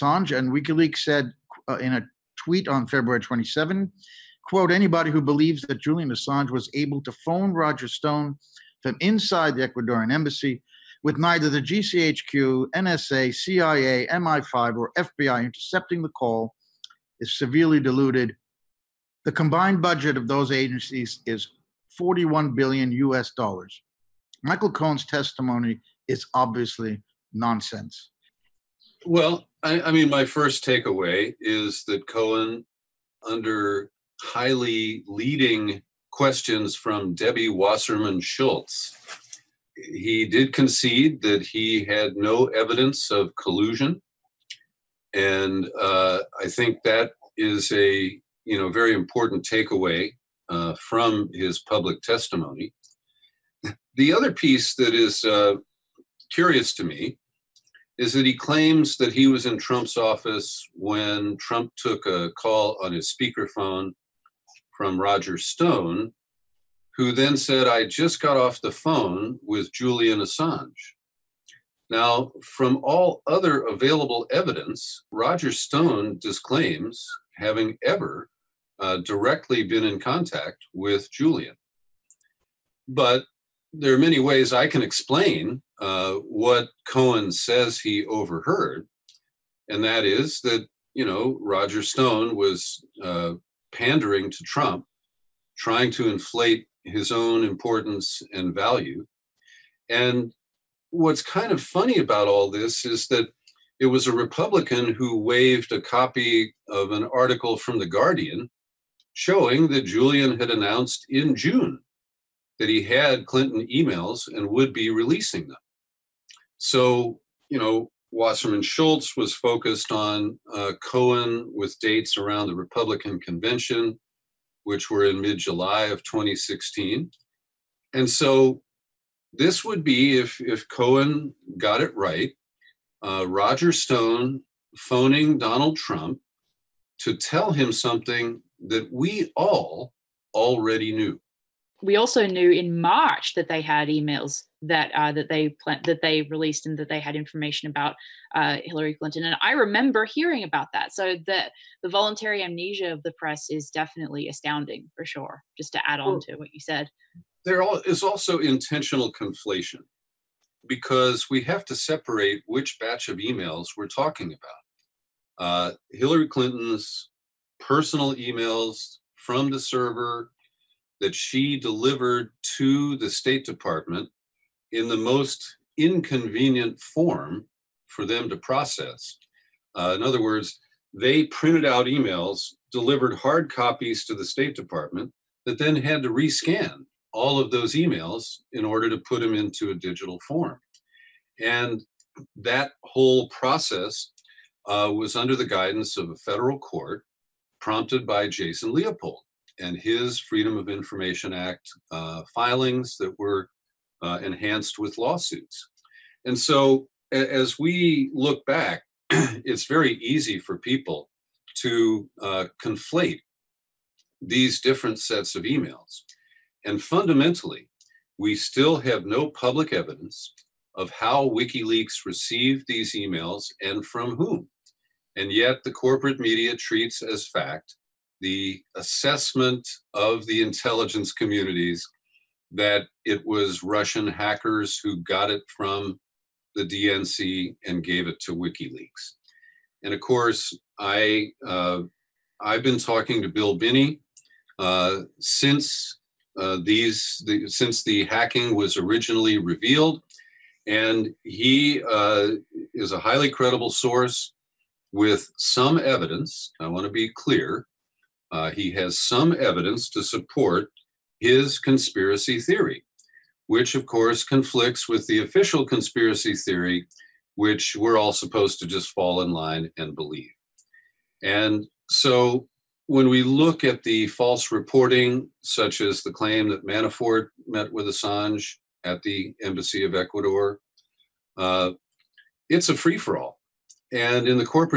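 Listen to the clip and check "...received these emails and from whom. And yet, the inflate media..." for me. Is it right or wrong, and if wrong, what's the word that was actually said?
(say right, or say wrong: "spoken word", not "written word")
wrong: "corporate", not "inflate".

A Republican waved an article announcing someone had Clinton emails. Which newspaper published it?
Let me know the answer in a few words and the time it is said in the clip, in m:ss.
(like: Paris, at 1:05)
The Guardian, at 1:47.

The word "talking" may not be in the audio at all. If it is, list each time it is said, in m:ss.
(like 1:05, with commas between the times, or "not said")
2:43, 4:02.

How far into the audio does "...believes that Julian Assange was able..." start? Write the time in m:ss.
0:05.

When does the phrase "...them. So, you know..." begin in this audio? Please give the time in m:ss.
1:55.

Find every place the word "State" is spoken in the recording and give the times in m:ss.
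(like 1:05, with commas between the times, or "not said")
2:53, 3:04.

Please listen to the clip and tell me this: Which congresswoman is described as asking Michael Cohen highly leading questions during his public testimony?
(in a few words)
Debbie Wasserman Schultz.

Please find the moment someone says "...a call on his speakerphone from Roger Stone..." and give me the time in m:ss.
1:02.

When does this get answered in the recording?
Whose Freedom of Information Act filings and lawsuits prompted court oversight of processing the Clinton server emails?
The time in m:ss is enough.
3:18.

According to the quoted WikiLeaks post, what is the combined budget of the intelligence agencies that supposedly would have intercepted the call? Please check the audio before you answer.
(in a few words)
$41 billion.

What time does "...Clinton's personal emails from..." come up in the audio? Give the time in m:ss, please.
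2:46.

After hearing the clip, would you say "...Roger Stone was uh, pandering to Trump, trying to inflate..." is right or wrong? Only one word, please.
right.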